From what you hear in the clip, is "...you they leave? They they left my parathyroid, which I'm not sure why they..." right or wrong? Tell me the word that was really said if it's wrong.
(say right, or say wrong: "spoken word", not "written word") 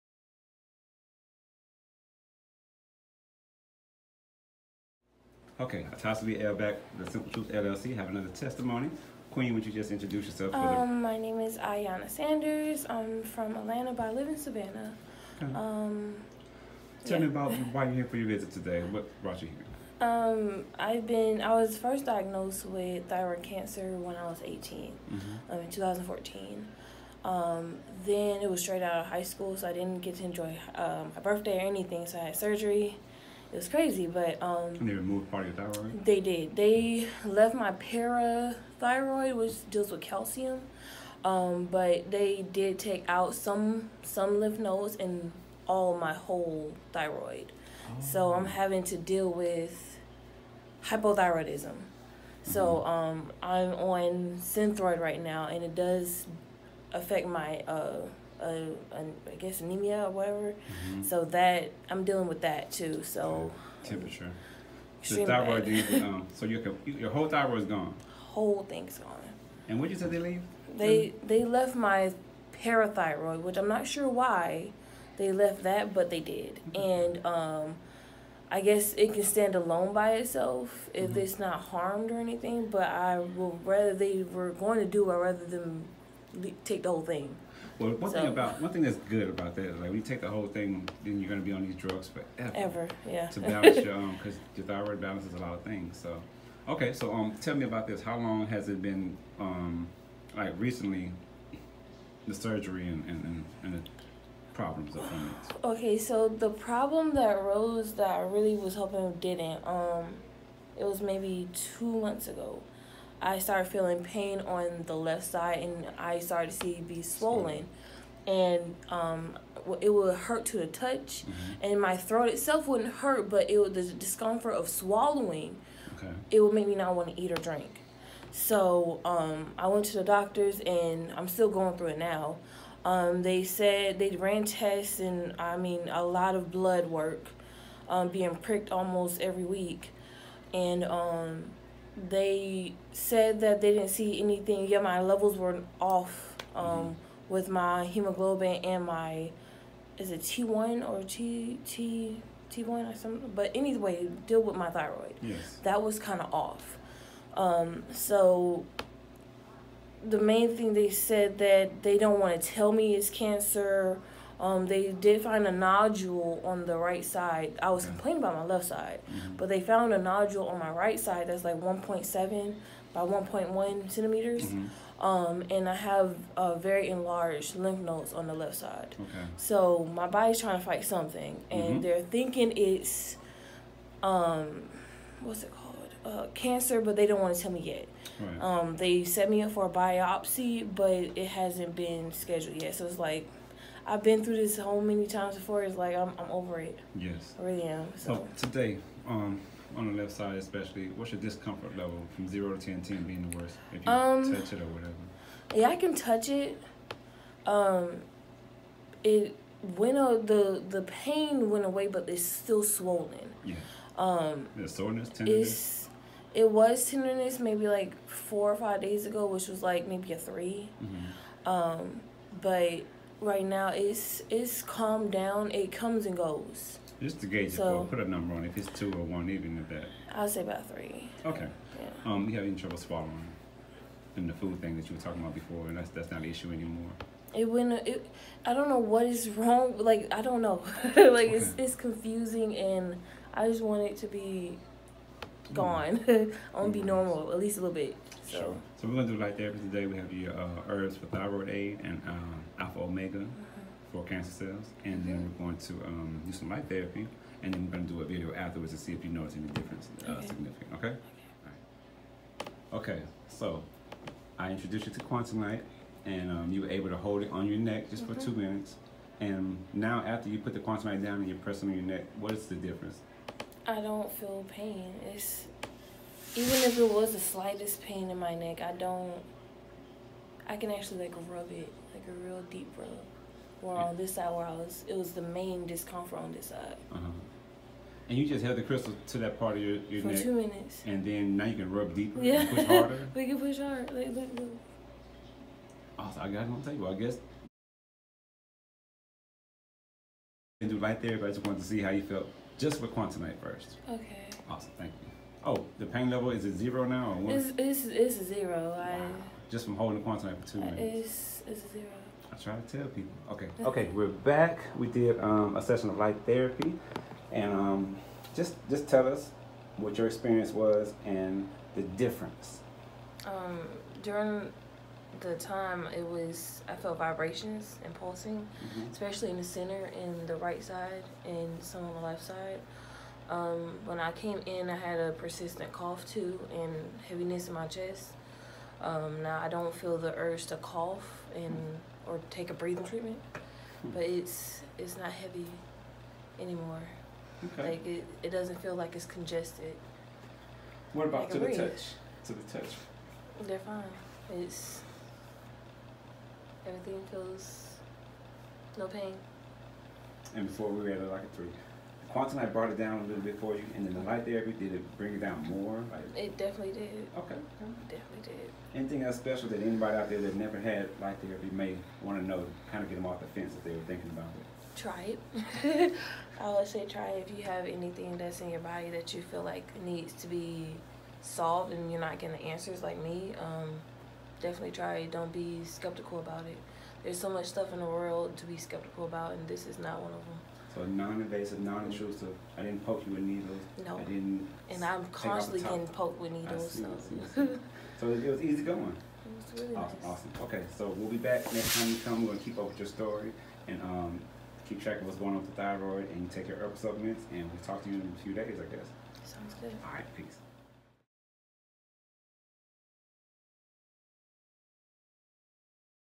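right.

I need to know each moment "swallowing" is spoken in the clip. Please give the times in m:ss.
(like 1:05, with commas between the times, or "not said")
2:04, 3:52.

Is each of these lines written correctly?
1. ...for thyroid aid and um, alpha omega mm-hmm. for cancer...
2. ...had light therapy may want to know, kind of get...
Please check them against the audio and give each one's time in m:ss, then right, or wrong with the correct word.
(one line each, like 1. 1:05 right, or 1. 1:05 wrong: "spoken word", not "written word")
1. 4:10 right
2. 6:10 right.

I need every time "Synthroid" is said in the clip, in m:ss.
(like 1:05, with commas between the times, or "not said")
0:54.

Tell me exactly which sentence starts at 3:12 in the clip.
So it's like I've been through this so many times before.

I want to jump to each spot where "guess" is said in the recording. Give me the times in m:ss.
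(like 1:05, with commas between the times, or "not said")
0:59, 1:18, 4:56, 6:48.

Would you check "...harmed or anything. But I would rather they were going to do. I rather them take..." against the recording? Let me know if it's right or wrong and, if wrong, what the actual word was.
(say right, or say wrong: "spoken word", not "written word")
right.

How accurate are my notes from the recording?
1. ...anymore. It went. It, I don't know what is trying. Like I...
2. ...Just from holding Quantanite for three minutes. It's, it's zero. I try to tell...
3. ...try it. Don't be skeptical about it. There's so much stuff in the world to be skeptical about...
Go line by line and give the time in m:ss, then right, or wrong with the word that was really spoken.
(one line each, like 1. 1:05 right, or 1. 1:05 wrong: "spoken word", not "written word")
1. 3:56 wrong: "wrong", not "trying"
2. 5:09 wrong: "two", not "three"
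3. 6:24 right.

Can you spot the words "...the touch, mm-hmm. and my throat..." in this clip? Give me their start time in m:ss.
2:00.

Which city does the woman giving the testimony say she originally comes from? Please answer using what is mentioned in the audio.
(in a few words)
Atlanta.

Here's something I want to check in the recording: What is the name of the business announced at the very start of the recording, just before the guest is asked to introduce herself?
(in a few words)
The Simple Truth LLC.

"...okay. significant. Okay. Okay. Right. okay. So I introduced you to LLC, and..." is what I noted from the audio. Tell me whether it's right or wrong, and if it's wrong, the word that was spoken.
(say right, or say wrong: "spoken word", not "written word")
wrong: "Quantanite", not "LLC".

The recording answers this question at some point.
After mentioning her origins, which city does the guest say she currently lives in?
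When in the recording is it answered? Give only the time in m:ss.
0:14.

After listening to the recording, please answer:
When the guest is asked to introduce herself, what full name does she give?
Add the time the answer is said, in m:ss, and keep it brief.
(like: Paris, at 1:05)
Ayana Sanders, at 0:11.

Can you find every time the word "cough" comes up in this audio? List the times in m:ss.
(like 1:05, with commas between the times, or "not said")
5:35, 5:40.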